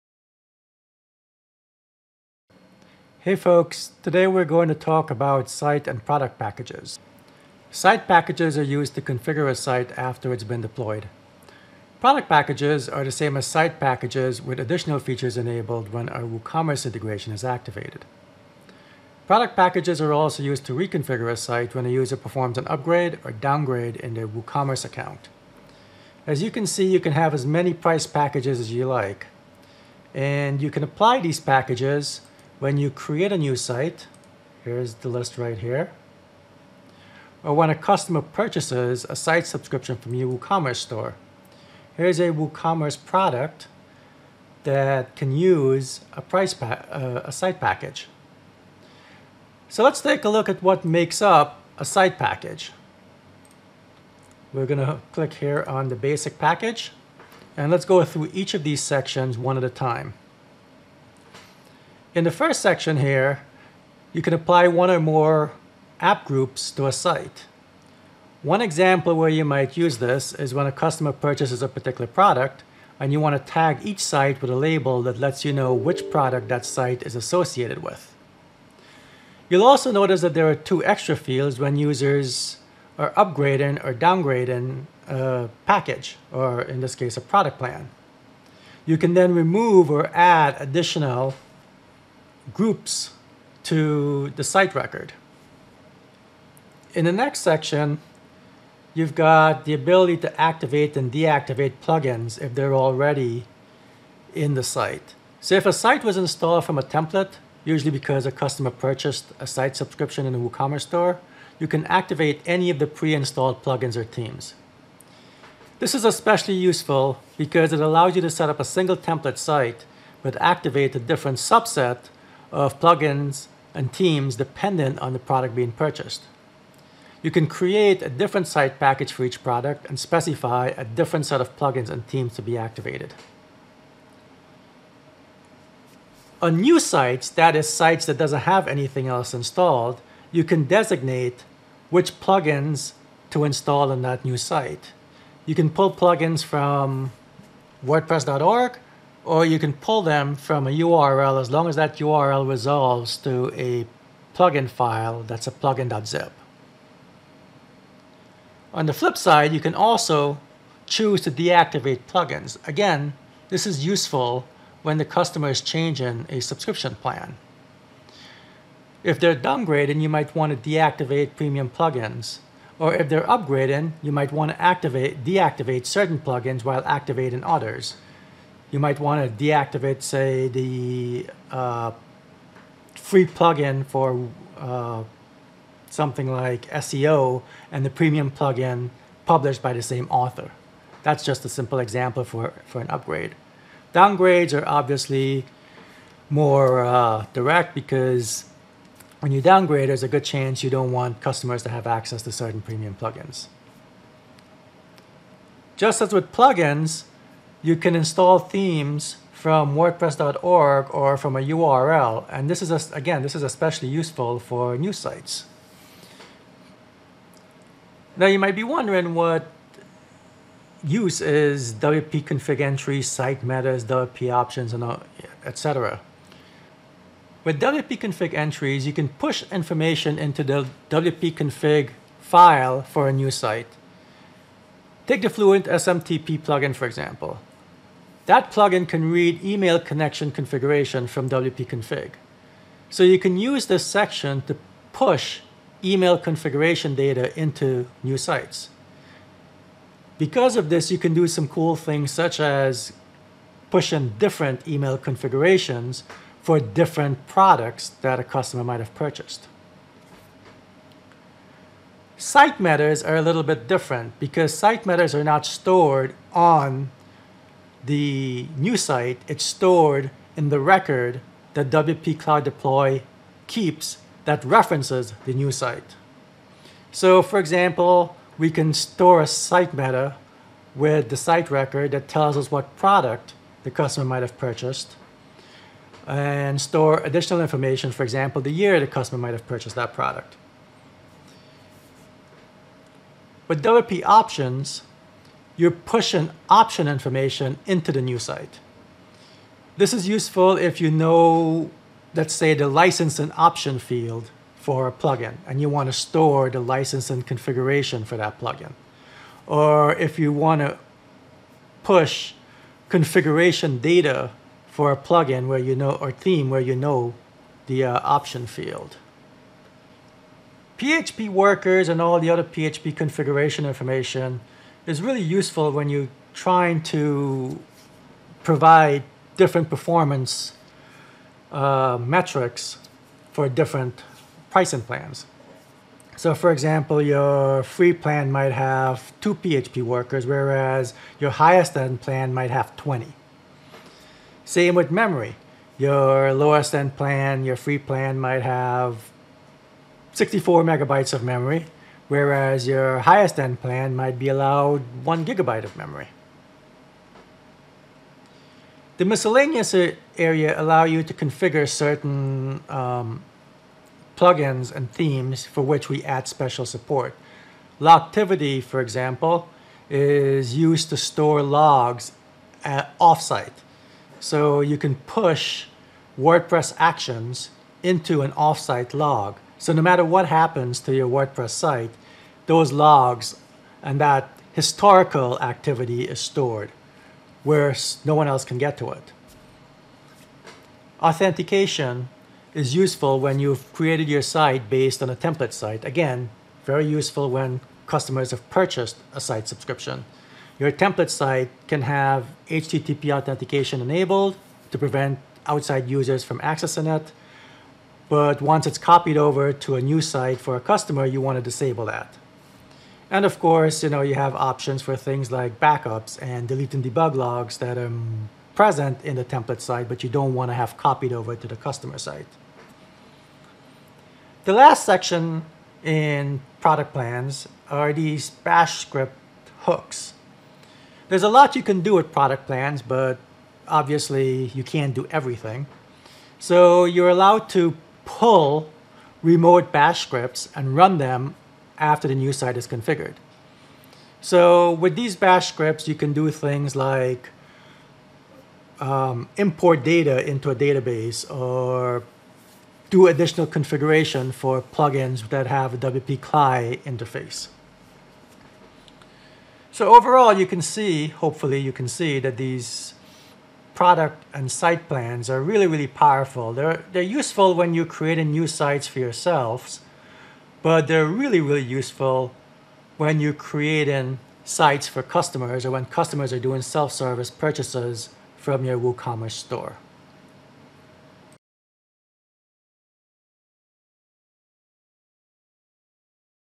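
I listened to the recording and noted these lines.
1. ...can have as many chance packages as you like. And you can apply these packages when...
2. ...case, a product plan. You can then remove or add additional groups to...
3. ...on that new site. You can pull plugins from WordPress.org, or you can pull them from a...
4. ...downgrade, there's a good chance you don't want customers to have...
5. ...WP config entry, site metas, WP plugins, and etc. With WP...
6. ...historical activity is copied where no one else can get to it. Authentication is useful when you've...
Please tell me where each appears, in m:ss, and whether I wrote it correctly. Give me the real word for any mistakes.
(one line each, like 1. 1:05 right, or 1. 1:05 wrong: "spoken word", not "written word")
1. 0:26 wrong: "price", not "chance"
2. 1:26 right
3. 2:23 right
4. 3:19 right
5. 3:41 wrong: "options", not "plugins"
6. 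6:24 wrong: "stored", not "copied".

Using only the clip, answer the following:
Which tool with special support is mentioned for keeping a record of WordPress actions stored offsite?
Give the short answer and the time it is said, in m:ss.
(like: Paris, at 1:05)
Logtivity, at 6:07.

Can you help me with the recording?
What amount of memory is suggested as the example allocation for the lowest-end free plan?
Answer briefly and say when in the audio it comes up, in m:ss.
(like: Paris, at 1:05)
64 megabytes, at 5:50.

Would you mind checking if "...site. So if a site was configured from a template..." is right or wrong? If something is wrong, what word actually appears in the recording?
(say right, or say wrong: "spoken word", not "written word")
wrong: "installed", not "configured".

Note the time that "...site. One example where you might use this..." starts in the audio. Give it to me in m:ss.
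1:06.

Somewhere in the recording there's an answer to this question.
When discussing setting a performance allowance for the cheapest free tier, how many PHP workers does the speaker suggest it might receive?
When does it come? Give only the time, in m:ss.
5:39.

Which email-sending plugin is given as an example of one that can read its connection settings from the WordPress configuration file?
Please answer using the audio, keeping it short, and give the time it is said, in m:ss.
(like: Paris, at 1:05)
Fluent SMTP, at 3:55.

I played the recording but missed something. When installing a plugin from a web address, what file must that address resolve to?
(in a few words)
plugin.zip.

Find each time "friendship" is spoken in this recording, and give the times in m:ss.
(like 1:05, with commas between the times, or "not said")
not said.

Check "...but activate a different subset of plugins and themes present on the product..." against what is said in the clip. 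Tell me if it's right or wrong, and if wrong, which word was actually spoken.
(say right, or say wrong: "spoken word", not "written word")
wrong: "dependent", not "present".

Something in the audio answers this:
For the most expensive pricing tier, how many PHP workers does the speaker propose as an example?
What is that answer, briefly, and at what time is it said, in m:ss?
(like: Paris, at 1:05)
20, at 5:42.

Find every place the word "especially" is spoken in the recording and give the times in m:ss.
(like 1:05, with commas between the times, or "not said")
1:56, 3:33.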